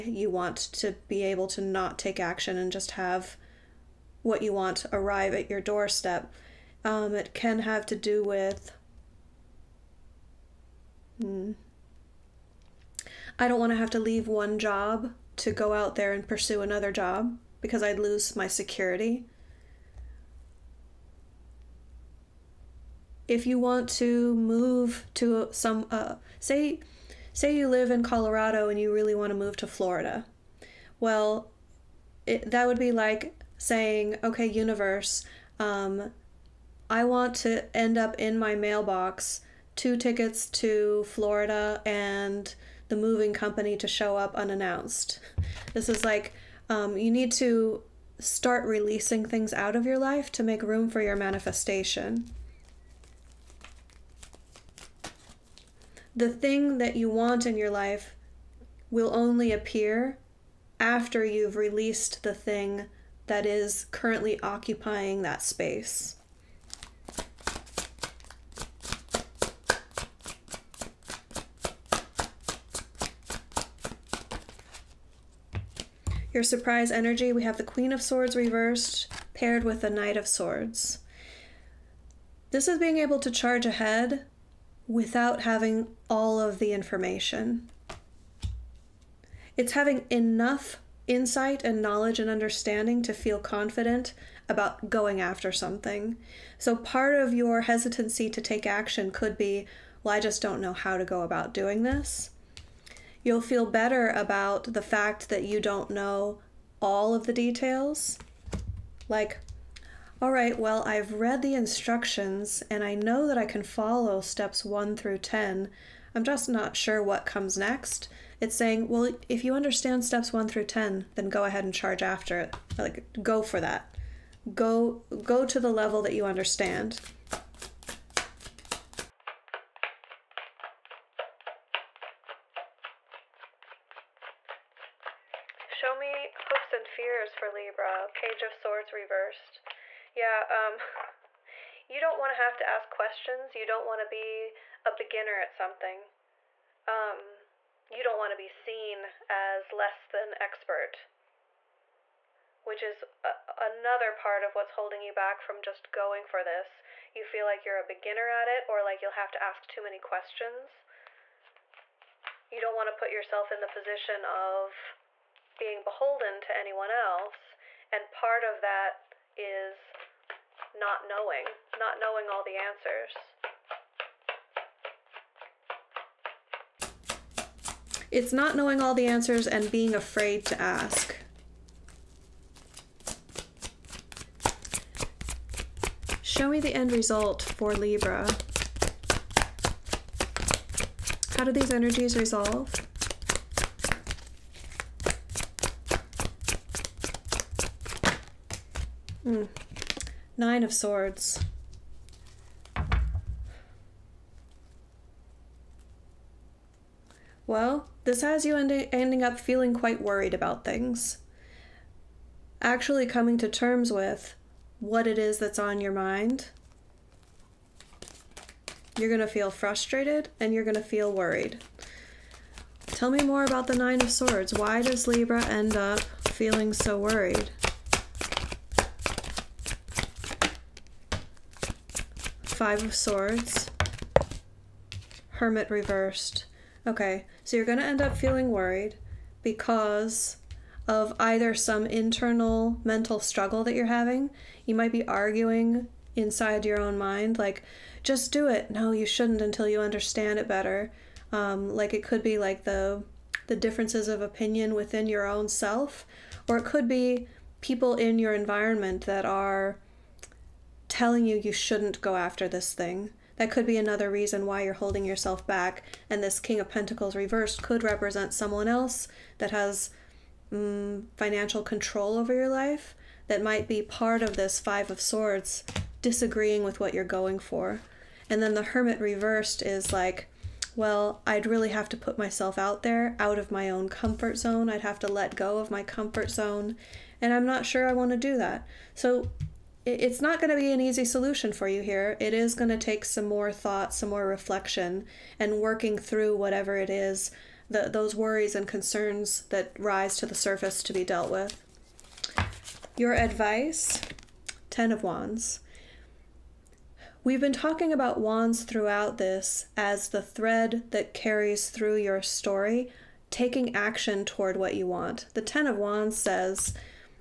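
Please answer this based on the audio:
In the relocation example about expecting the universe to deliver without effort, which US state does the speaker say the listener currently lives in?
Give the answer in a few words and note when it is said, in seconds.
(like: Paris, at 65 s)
Colorado, at 28 s.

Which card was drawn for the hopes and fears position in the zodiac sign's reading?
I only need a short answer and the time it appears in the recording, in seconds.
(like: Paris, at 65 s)
Page of Swords reversed, at 138 s.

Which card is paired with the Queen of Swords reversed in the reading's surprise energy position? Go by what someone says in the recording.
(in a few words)
Knight of Swords.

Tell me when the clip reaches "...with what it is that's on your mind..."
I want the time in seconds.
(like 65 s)
213 s.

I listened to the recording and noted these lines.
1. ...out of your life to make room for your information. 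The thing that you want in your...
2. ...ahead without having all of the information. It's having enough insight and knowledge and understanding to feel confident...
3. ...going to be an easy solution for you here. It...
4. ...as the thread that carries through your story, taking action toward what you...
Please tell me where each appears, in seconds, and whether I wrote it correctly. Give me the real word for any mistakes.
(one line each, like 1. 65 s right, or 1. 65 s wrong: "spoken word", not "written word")
1. 49 s wrong: "manifestation", not "information"
2. 83 s right
3. 290 s right
4. 309 s right.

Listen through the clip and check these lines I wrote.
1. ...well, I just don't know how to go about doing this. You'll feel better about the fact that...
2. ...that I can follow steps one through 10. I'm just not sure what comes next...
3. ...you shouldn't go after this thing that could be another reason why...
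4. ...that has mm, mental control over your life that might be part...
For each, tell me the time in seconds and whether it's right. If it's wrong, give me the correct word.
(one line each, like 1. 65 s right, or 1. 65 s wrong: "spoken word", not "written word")
1. 100 s right
2. 113 s right
3. 261 s right
4. 269 s wrong: "financial", not "mental".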